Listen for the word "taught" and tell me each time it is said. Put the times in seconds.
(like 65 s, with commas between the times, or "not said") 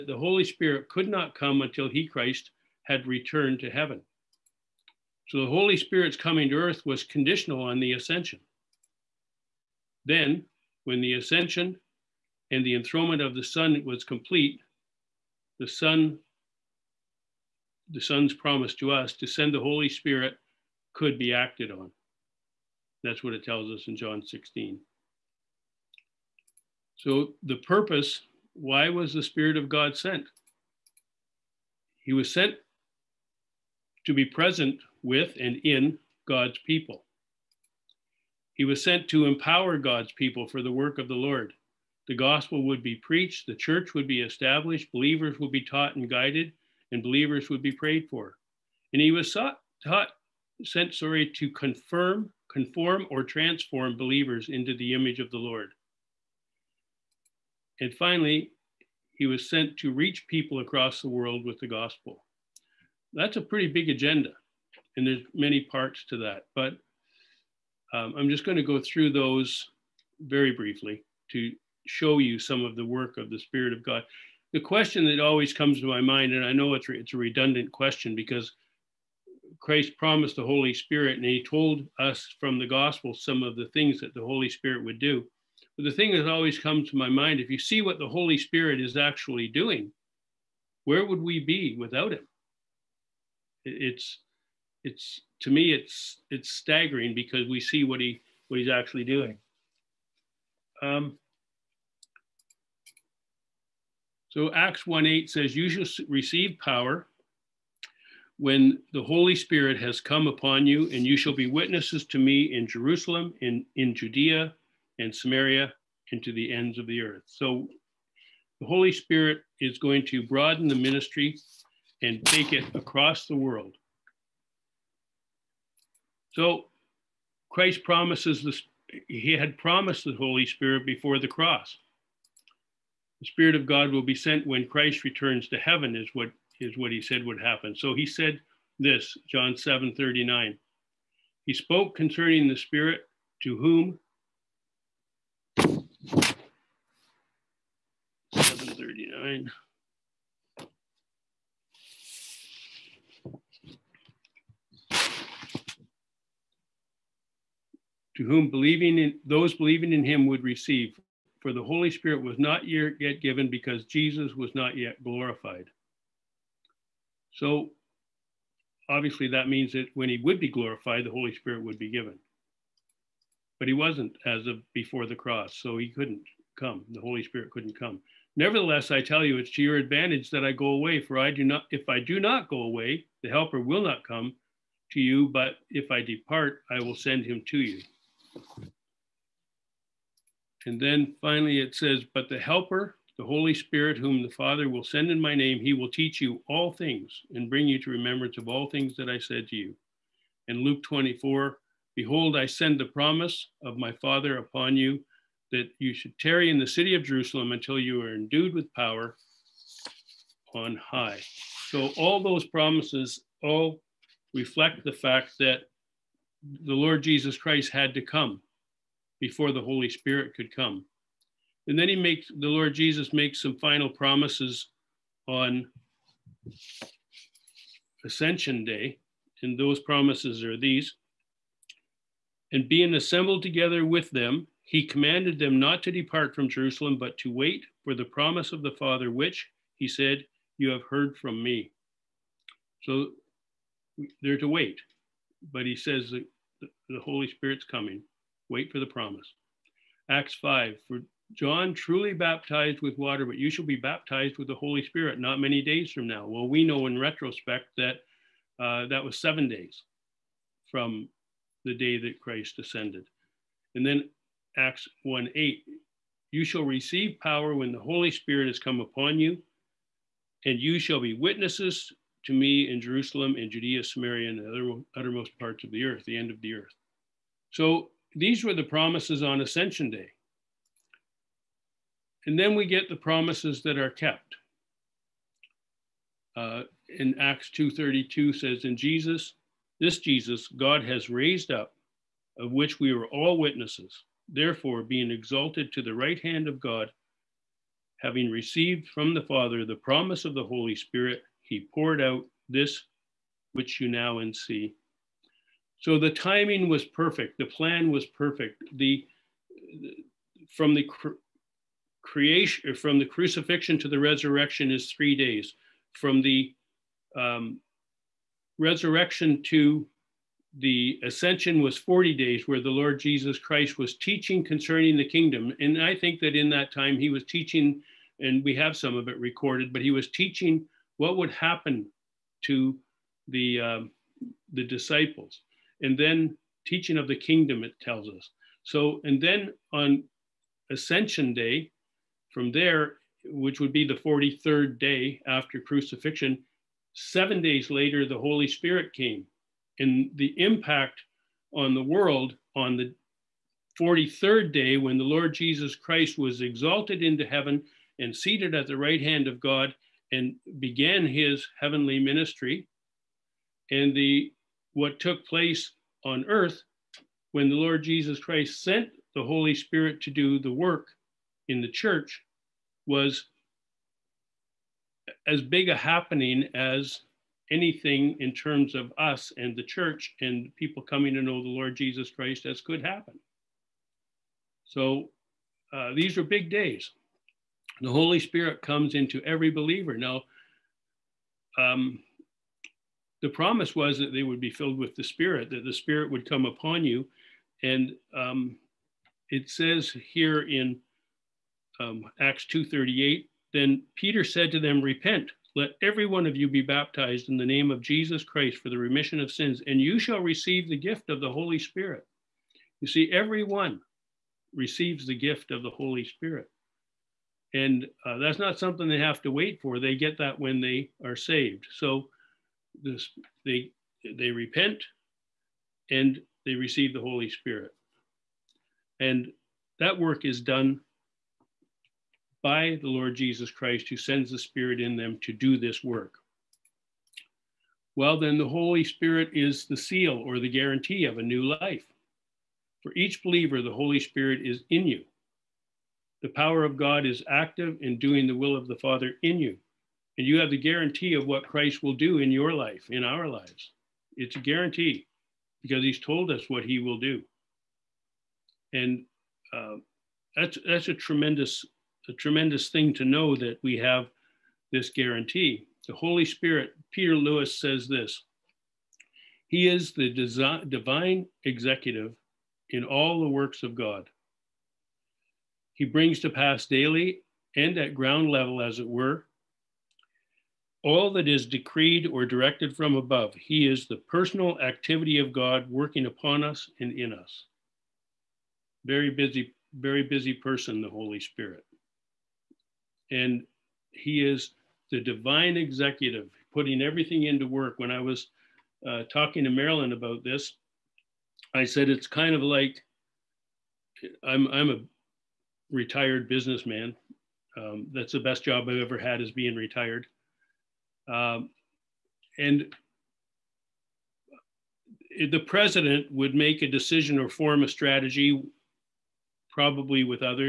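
45 s, 49 s.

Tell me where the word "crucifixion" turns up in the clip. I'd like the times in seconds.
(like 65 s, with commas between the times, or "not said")
313 s, 345 s.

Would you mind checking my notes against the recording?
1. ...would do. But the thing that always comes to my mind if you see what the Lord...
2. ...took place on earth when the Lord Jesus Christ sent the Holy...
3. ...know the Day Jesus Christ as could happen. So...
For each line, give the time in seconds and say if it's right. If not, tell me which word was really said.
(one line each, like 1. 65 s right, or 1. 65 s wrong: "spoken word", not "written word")
1. 84 s wrong: "Holy", not "Lord"
2. 364 s right
3. 381 s wrong: "Lord", not "Day".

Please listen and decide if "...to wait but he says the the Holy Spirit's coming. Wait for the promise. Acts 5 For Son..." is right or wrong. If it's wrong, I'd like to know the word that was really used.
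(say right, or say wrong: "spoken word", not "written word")
wrong: "John", not "Son".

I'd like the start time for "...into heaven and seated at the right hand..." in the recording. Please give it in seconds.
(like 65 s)
357 s.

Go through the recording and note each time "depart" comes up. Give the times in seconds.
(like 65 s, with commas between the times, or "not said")
186 s, 235 s.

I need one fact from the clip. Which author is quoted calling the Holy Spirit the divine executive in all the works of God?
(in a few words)
Peter Lewis.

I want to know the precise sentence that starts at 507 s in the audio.
Um, that's the best job I've ever had is being retired.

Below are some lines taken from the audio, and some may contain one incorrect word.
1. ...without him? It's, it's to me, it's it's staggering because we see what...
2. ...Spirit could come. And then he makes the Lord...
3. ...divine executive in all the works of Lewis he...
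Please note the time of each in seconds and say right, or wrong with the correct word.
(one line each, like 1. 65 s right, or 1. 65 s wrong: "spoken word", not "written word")
1. 91 s right
2. 219 s right
3. 470 s wrong: "God", not "Lewis".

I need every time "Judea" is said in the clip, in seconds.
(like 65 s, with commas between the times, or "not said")
113 s, 273 s.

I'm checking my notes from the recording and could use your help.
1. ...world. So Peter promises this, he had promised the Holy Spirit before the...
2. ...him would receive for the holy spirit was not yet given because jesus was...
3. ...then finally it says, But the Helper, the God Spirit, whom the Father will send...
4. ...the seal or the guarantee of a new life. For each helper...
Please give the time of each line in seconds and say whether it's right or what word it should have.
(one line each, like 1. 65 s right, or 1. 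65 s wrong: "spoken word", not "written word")
1. 123 s wrong: "Christ", not "Peter"
2. 160 s right
3. 190 s wrong: "Holy", not "God"
4. 439 s wrong: "believer", not "helper".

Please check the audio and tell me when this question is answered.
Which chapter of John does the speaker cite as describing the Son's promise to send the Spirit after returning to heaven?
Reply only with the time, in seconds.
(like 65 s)
23 s.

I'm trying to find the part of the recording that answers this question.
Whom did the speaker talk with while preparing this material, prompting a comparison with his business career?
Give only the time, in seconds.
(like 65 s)
499 s.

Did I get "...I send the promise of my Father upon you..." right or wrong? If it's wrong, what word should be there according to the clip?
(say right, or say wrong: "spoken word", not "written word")
right.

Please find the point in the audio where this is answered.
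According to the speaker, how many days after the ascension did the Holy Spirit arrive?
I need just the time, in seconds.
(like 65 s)
346 s.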